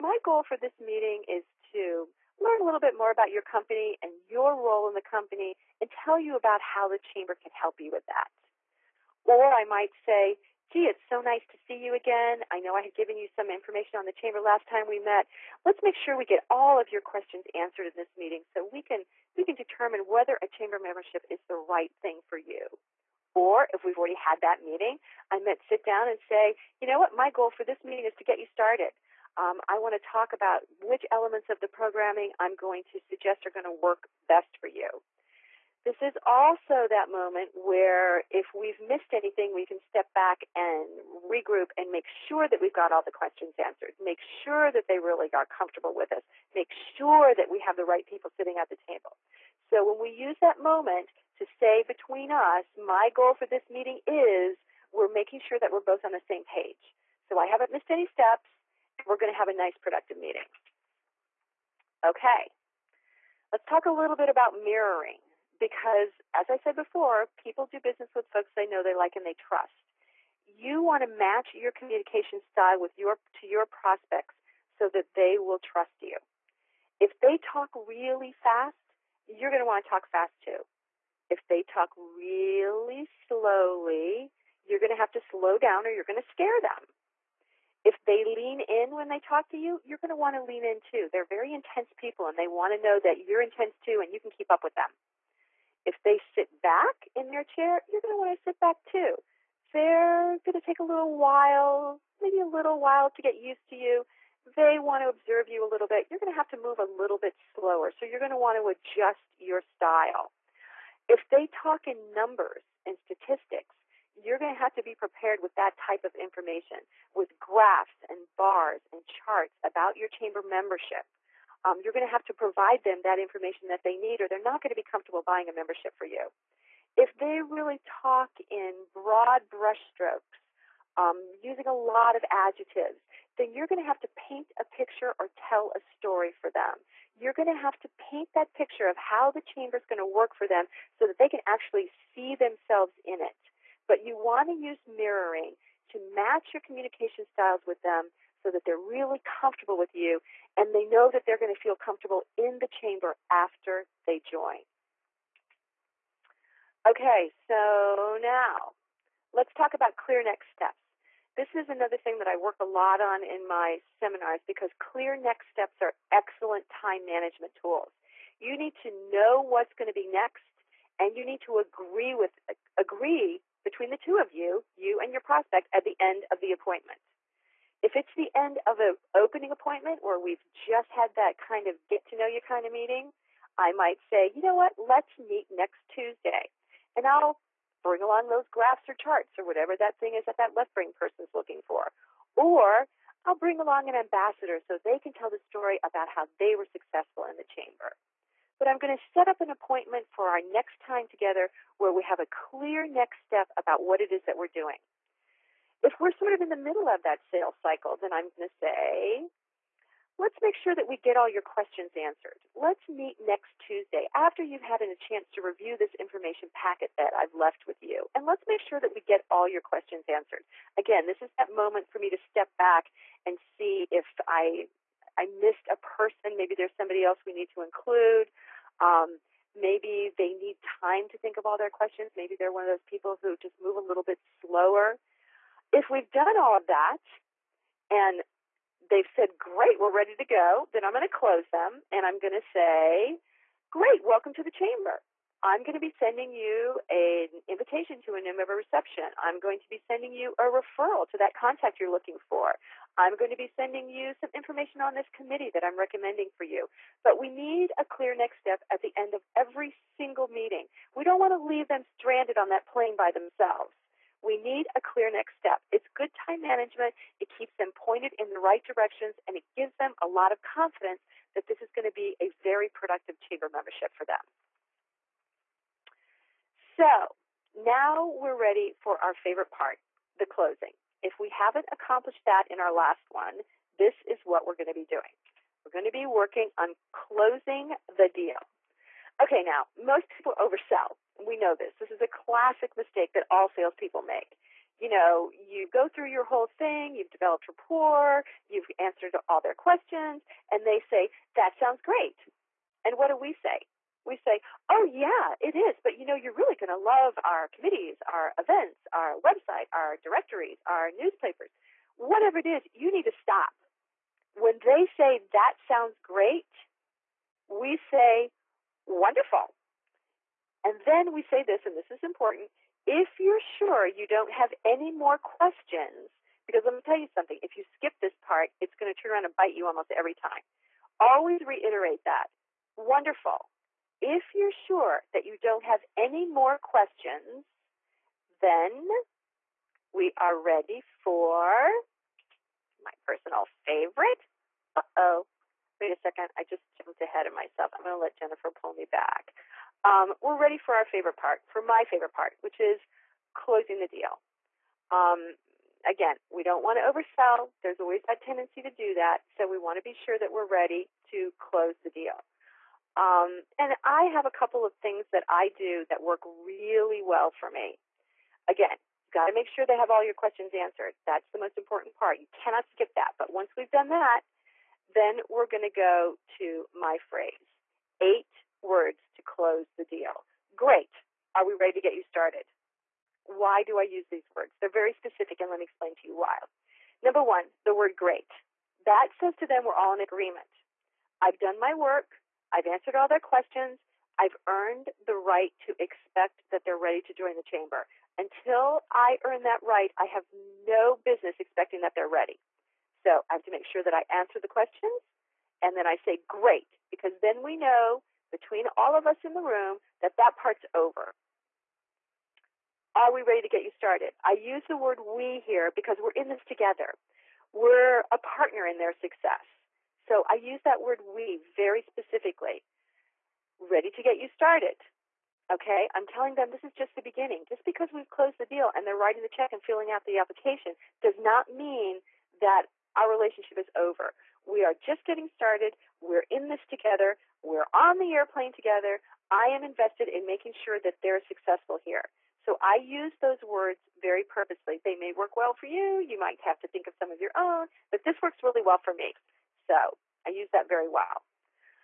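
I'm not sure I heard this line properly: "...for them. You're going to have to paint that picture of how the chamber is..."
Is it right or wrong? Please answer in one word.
right.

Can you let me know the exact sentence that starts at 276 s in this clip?
So now we're ready for our favorite part, the closing.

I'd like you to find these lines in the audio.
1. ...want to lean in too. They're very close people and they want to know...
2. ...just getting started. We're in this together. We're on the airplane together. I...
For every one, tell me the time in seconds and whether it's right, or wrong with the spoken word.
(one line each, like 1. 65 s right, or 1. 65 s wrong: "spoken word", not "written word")
1. 90 s wrong: "intense", not "close"
2. 434 s right.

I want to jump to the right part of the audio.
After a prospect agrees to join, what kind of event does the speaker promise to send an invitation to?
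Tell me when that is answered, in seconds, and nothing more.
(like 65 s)
248 s.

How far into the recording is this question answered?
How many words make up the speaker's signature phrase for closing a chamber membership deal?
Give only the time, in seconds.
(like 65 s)
377 s.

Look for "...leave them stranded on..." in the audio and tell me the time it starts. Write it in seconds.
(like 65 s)
261 s.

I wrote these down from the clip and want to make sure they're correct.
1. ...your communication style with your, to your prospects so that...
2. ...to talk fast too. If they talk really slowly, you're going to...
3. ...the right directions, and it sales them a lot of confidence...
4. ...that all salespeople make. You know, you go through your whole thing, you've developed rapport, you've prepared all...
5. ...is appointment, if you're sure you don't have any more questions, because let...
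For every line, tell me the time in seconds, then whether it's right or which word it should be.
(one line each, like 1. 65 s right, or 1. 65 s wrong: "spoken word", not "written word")
1. 71 s right
2. 79 s right
3. 268 s wrong: "gives", not "sales"
4. 293 s wrong: "answered", not "prepared"
5. 321 s wrong: "important", not "appointment".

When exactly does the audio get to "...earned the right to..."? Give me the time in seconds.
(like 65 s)
394 s.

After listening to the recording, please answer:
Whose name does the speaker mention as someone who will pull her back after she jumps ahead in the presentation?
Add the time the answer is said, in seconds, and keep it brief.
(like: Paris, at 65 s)
Jennifer, at 348 s.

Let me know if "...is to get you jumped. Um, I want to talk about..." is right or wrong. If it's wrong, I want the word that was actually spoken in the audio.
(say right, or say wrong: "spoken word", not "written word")
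wrong: "started", not "jumped".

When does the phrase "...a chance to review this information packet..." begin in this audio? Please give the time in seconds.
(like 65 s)
214 s.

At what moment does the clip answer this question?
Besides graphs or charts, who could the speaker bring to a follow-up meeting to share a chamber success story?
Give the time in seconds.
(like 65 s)
193 s.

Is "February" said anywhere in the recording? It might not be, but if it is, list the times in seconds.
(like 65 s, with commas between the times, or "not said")
not said.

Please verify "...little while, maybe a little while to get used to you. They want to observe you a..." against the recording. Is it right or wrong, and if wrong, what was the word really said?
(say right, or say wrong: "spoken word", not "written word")
right.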